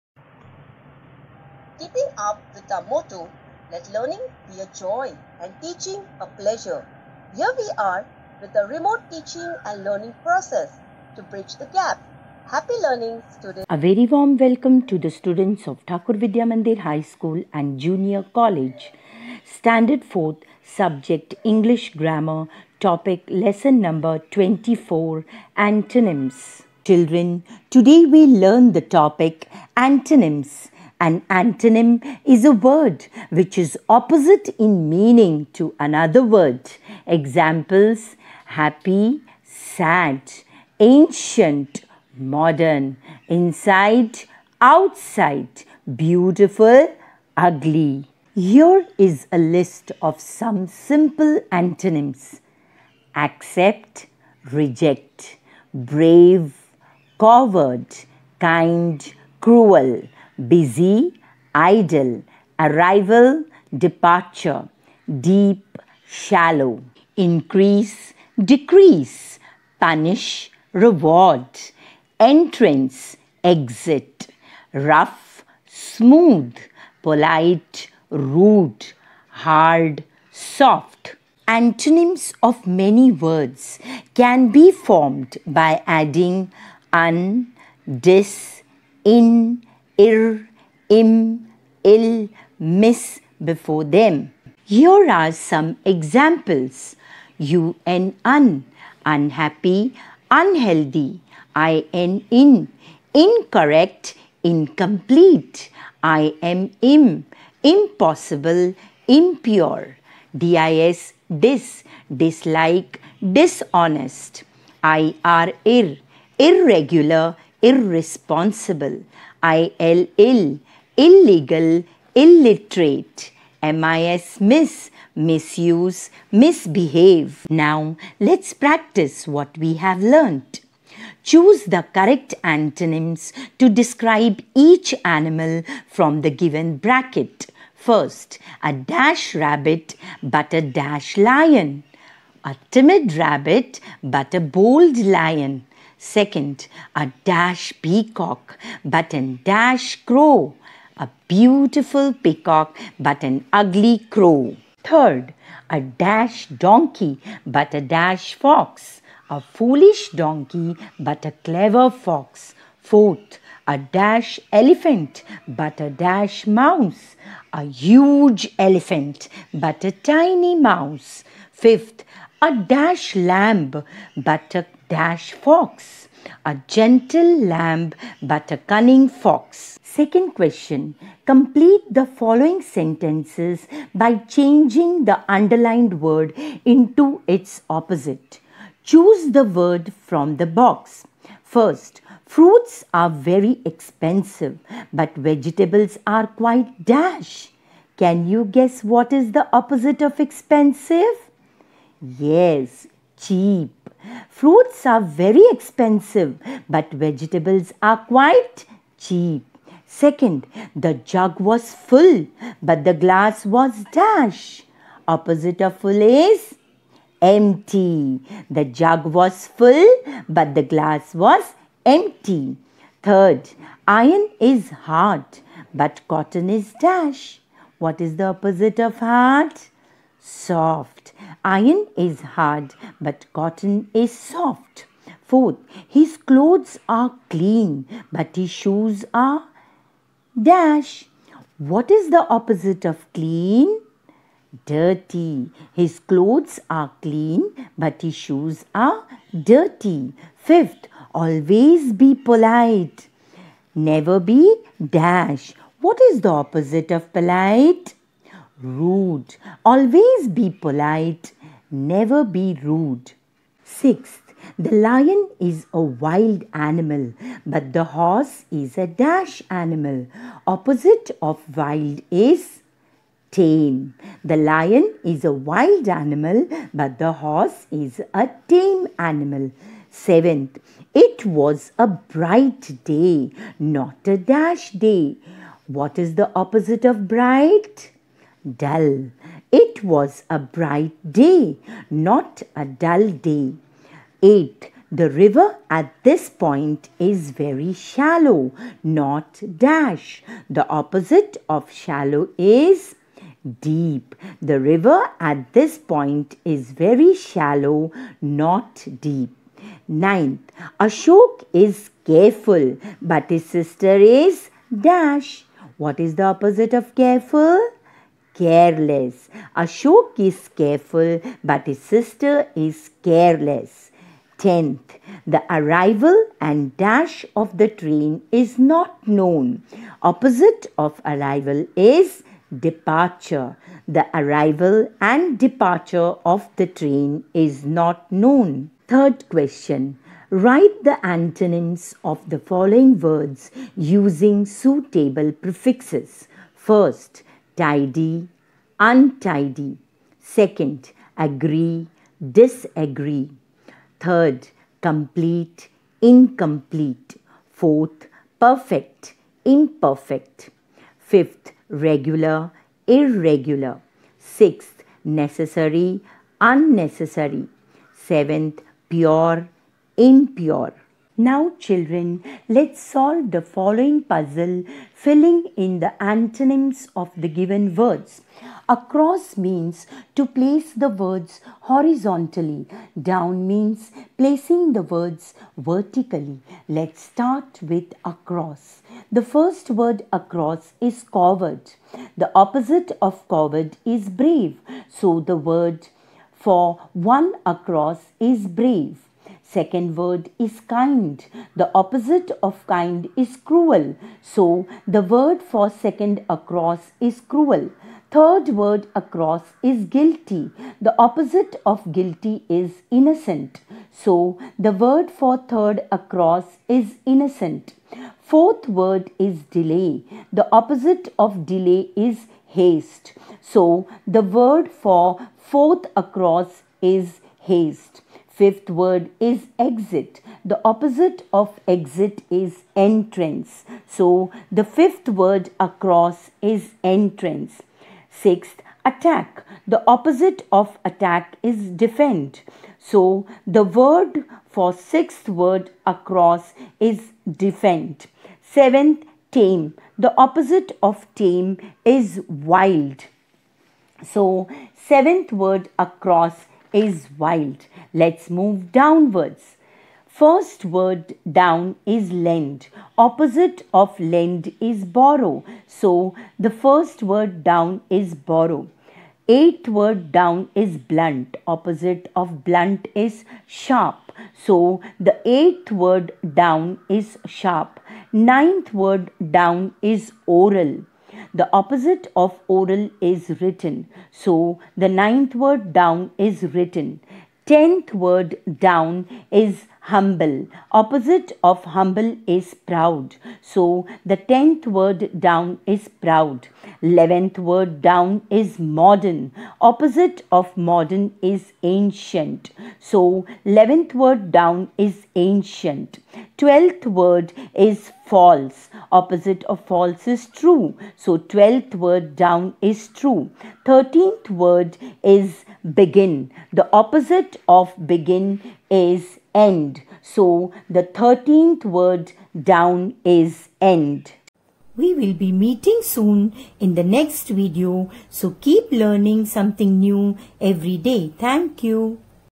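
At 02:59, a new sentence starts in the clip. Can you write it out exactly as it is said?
Second question Complete the following sentences by changing the underlined word into its opposite.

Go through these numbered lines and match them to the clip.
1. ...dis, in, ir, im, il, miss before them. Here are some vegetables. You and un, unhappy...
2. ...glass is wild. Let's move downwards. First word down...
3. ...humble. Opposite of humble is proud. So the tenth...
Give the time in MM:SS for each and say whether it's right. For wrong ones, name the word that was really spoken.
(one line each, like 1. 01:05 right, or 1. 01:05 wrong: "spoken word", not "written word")
1. 01:27 wrong: "examples", not "vegetables"
2. 07:35 wrong: "across", not "glass"
3. 08:09 right.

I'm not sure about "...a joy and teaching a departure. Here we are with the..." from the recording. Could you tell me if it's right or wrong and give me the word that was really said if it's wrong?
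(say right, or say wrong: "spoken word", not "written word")
wrong: "pleasure", not "departure".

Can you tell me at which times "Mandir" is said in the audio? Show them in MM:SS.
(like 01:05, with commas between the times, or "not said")
00:16.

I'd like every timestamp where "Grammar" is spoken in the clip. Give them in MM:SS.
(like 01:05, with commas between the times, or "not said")
00:21.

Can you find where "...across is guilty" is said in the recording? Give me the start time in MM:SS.
06:48.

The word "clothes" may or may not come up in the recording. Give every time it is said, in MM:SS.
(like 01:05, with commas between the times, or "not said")
03:56, 04:05.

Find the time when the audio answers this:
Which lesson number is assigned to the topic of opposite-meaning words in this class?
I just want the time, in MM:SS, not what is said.
00:24.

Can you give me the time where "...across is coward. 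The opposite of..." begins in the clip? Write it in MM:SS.
06:30.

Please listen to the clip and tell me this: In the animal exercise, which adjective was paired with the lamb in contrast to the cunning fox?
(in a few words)
gentle.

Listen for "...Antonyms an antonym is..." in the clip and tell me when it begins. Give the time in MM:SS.
00:29.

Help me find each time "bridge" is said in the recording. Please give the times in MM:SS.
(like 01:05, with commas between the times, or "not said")
00:11.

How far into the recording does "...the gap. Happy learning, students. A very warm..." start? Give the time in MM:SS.
00:11.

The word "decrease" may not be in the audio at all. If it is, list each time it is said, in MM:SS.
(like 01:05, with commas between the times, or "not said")
01:08.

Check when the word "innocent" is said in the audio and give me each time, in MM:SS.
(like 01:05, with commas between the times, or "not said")
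06:52, 06:57.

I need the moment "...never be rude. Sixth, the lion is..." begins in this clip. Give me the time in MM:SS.
04:21.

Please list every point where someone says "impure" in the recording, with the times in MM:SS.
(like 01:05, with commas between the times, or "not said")
01:49, 06:10.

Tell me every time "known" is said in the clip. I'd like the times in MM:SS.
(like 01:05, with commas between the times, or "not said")
05:29, 05:38.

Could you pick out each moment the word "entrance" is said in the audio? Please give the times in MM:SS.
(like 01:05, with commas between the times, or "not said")
01:12, 07:12, 07:16.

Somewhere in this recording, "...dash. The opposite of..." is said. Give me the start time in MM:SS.
04:59.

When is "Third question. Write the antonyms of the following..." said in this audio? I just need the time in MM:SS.
05:38.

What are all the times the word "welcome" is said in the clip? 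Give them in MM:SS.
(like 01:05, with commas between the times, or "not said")
00:14.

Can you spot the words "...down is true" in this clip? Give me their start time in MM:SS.
08:32.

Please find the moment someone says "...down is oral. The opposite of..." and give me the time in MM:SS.
07:59.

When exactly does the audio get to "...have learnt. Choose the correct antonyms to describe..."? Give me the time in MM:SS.
02:09.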